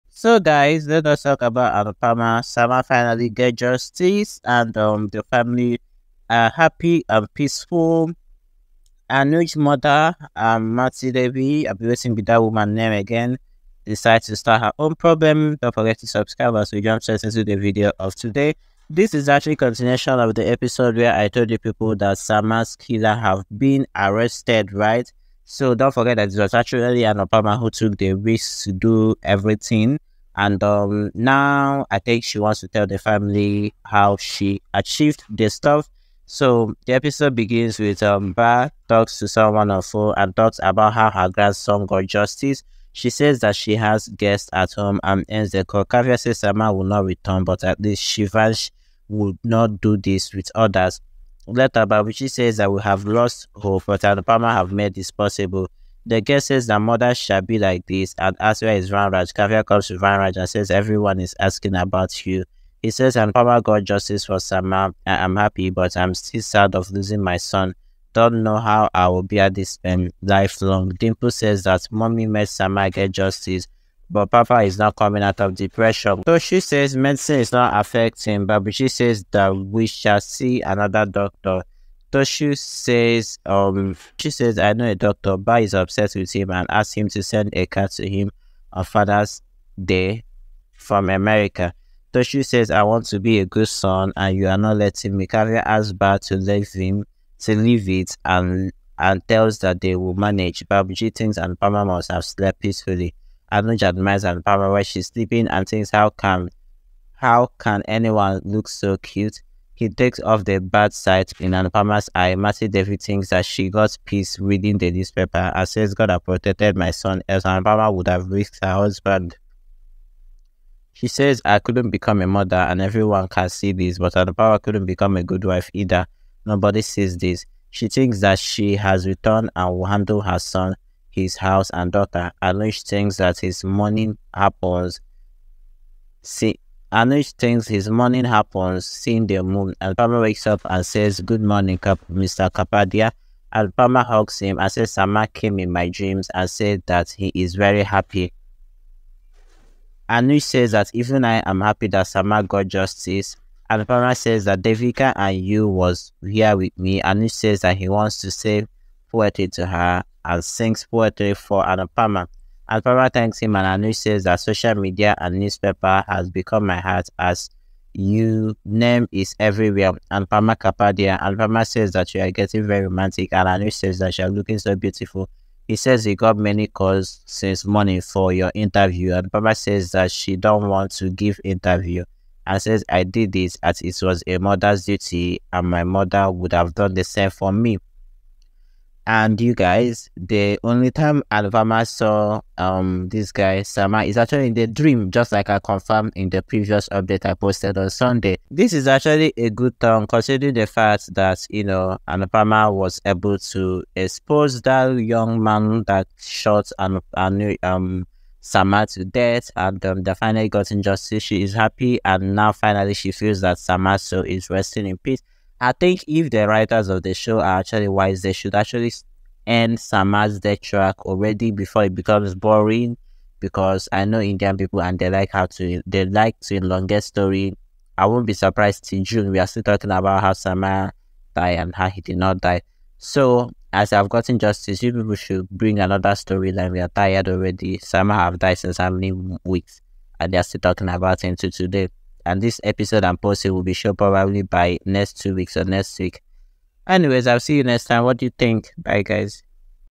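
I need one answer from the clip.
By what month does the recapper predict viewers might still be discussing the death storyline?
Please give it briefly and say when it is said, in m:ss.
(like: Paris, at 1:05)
June, at 3:49.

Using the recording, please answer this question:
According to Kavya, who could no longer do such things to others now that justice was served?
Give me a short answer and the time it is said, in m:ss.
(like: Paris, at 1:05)
Shivansh, at 0:48.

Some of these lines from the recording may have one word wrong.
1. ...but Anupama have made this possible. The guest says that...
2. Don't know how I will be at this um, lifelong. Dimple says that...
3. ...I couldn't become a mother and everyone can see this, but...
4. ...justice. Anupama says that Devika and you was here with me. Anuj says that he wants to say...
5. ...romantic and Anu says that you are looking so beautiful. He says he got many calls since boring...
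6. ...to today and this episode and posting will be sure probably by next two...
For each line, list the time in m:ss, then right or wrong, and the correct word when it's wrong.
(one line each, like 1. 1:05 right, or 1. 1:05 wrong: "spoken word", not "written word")
1. 0:53 right
2. 1:08 right
3. 2:01 right
4. 2:32 right
5. 2:52 wrong: "morning", not "boring"
6. 4:01 right.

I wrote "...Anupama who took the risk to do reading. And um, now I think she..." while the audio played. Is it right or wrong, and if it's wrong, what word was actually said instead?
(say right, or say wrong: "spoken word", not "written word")
wrong: "everything", not "reading".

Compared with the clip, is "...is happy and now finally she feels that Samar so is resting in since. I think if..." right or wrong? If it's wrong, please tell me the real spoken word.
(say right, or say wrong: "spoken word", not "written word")
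wrong: "peace", not "since".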